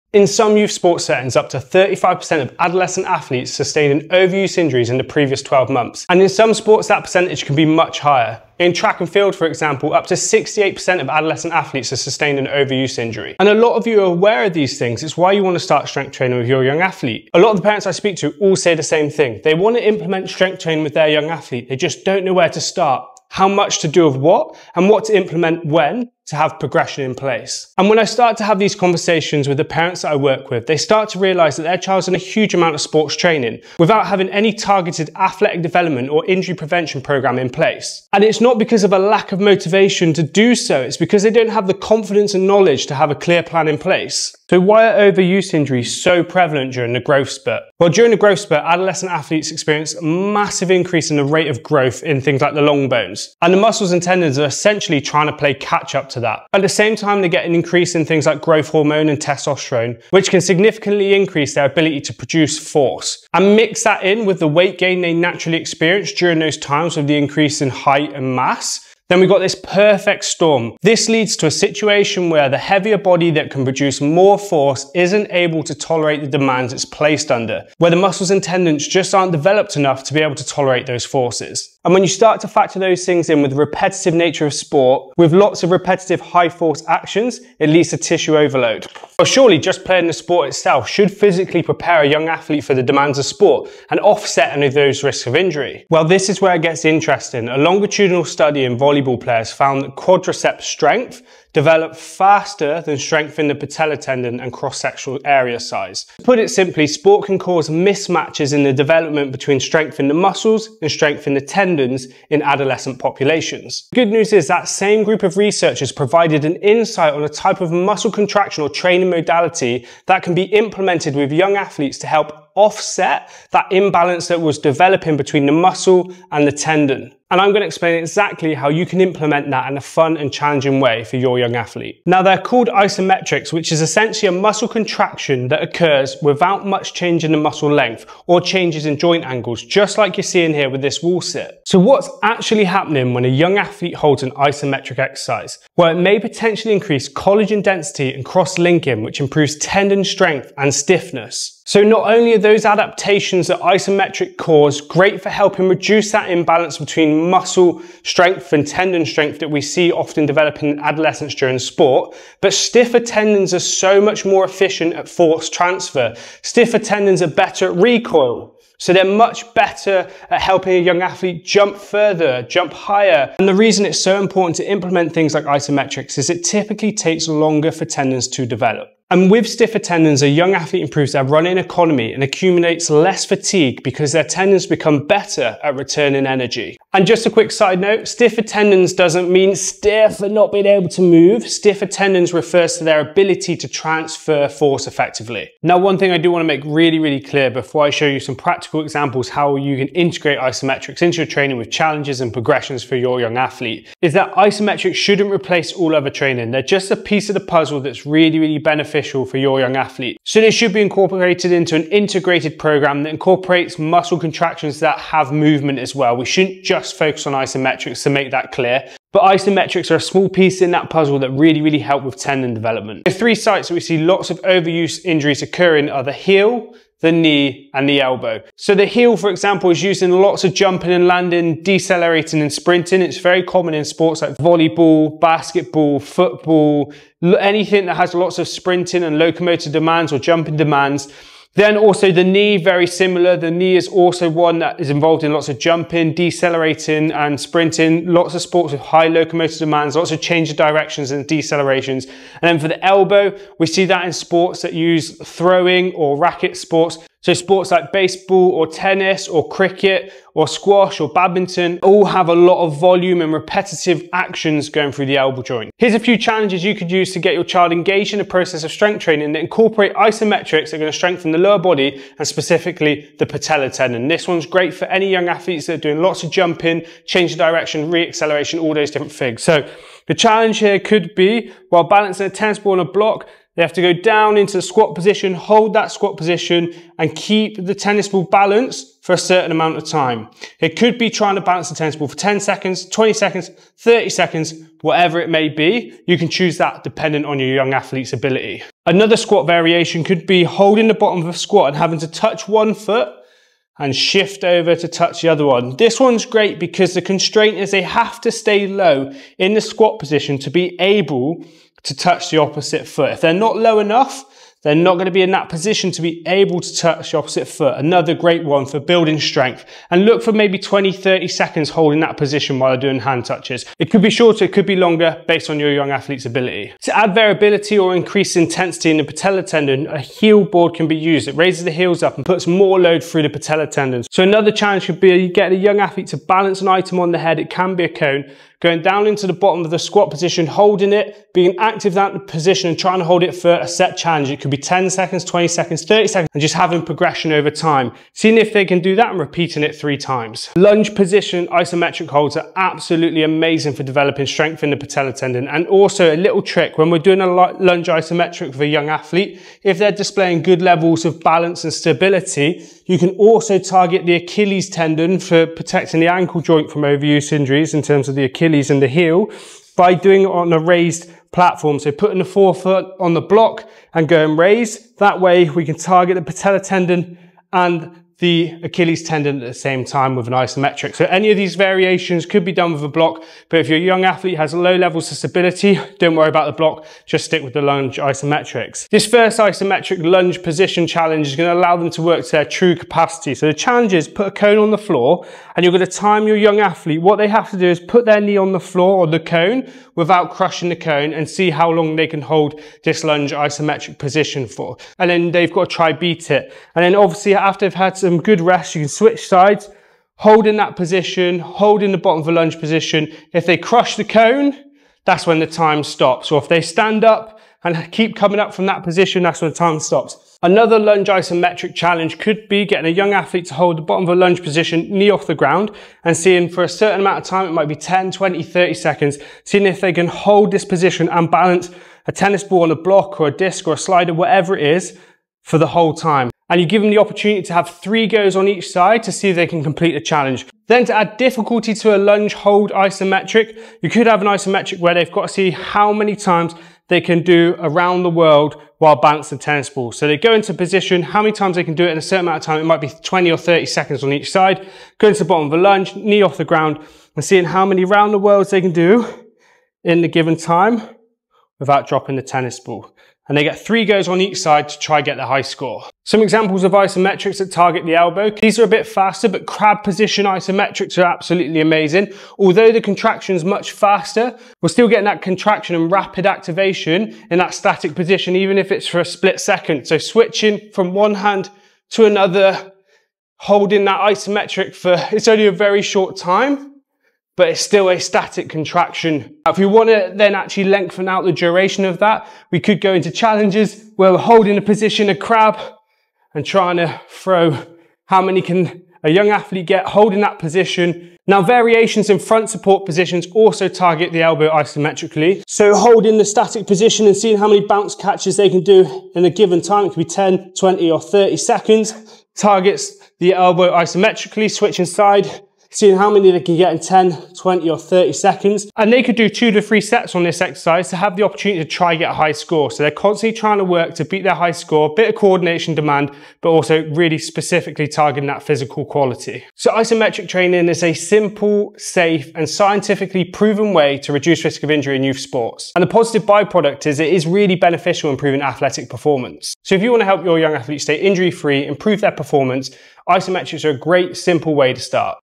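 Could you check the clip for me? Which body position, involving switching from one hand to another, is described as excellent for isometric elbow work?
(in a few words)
Crab position.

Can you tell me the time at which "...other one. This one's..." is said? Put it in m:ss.
5:05.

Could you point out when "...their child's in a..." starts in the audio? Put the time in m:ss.
0:31.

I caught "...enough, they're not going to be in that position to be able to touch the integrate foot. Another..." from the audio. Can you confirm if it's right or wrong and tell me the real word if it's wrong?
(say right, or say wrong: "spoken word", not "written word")
wrong: "opposite", not "integrate".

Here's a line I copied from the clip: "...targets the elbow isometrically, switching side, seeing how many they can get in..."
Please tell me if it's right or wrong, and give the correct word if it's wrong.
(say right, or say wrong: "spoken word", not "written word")
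right.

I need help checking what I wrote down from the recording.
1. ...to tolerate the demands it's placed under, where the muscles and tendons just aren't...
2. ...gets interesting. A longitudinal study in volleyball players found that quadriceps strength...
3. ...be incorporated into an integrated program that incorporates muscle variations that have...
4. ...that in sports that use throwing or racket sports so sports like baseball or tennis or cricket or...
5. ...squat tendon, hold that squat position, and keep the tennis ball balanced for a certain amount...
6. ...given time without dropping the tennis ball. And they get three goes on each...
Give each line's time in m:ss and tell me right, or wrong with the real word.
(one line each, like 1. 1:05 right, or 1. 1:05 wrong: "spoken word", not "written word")
1. 1:15 right
2. 1:36 right
3. 3:30 wrong: "contractions", not "variations"
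4. 4:13 right
5. 4:44 wrong: "position", not "tendon"
6. 7:40 right.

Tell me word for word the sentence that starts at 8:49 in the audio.
So isometric training is a simple, safe and scientifically proven way to reduce risk of injury in youth sports.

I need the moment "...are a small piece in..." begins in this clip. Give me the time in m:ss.
3:39.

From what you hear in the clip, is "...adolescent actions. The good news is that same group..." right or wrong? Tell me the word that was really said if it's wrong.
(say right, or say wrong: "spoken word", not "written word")
wrong: "populations", not "actions".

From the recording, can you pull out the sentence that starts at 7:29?
So they go into position, how many times they can do it in a certain amount of time.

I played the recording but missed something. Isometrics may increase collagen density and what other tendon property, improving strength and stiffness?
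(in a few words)
Cross-linking.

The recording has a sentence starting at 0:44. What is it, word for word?
So why are overuse injuries so prevalent during the growth spurt?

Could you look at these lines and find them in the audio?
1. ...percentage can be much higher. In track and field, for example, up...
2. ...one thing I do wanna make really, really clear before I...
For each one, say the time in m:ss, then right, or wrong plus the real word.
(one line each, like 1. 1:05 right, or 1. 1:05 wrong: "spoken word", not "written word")
1. 0:07 right
2. 3:15 right.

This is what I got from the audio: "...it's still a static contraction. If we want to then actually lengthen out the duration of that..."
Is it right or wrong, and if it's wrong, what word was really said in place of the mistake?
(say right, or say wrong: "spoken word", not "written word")
right.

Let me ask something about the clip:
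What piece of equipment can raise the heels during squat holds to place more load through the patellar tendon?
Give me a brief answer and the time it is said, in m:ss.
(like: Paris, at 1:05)
Heel board, at 5:29.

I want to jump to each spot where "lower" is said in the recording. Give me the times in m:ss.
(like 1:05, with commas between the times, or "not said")
4:31.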